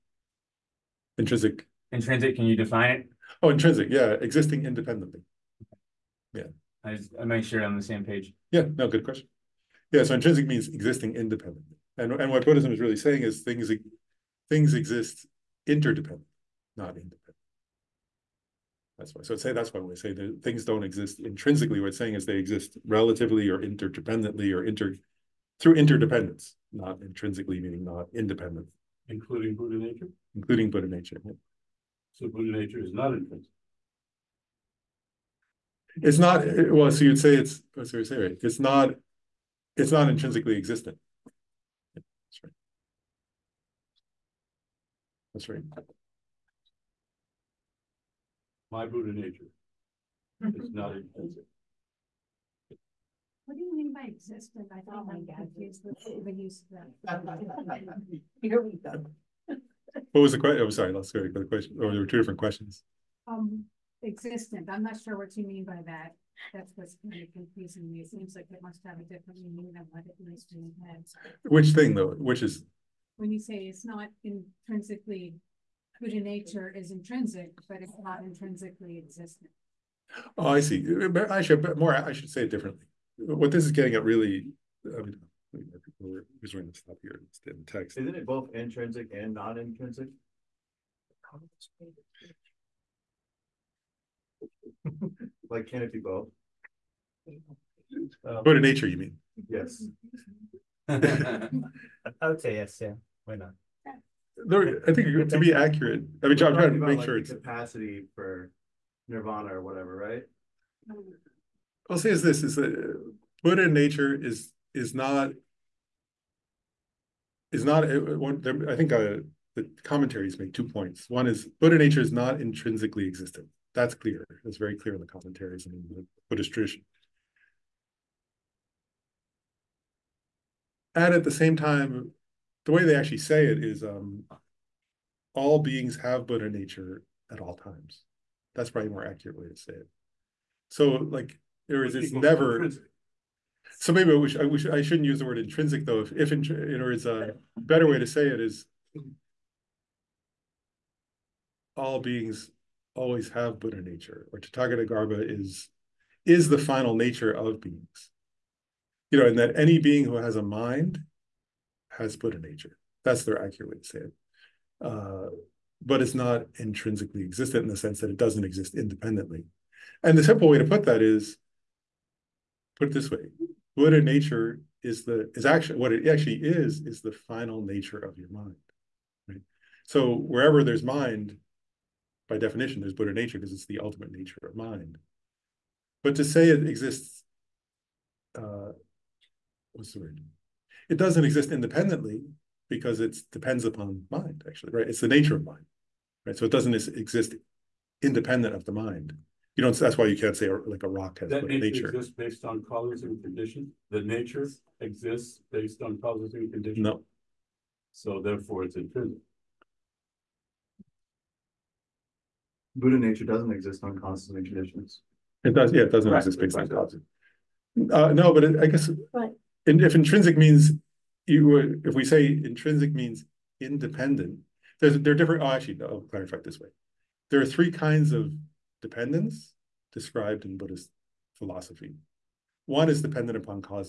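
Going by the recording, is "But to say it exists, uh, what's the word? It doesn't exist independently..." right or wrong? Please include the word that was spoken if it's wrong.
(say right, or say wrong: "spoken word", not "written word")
right.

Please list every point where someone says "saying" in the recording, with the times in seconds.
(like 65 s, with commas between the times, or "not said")
12 s, 21 s.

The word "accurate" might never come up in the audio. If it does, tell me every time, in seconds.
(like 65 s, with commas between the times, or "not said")
105 s, 139 s, 163 s.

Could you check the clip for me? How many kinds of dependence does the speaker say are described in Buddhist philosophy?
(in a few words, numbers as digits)
3.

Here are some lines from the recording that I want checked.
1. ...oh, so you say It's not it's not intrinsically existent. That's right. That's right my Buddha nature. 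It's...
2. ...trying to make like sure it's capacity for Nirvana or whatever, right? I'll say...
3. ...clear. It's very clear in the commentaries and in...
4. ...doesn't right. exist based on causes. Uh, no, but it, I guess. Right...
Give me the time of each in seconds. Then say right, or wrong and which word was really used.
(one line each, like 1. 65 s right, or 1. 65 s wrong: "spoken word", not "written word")
1. 37 s right
2. 106 s right
3. 123 s right
4. 215 s right.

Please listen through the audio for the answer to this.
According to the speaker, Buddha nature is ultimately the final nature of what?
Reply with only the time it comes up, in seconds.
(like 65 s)
177 s.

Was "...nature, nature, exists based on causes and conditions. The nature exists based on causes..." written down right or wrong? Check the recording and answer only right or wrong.
right.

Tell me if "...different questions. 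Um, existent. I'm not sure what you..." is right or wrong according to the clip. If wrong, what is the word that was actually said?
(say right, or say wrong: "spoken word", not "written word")
right.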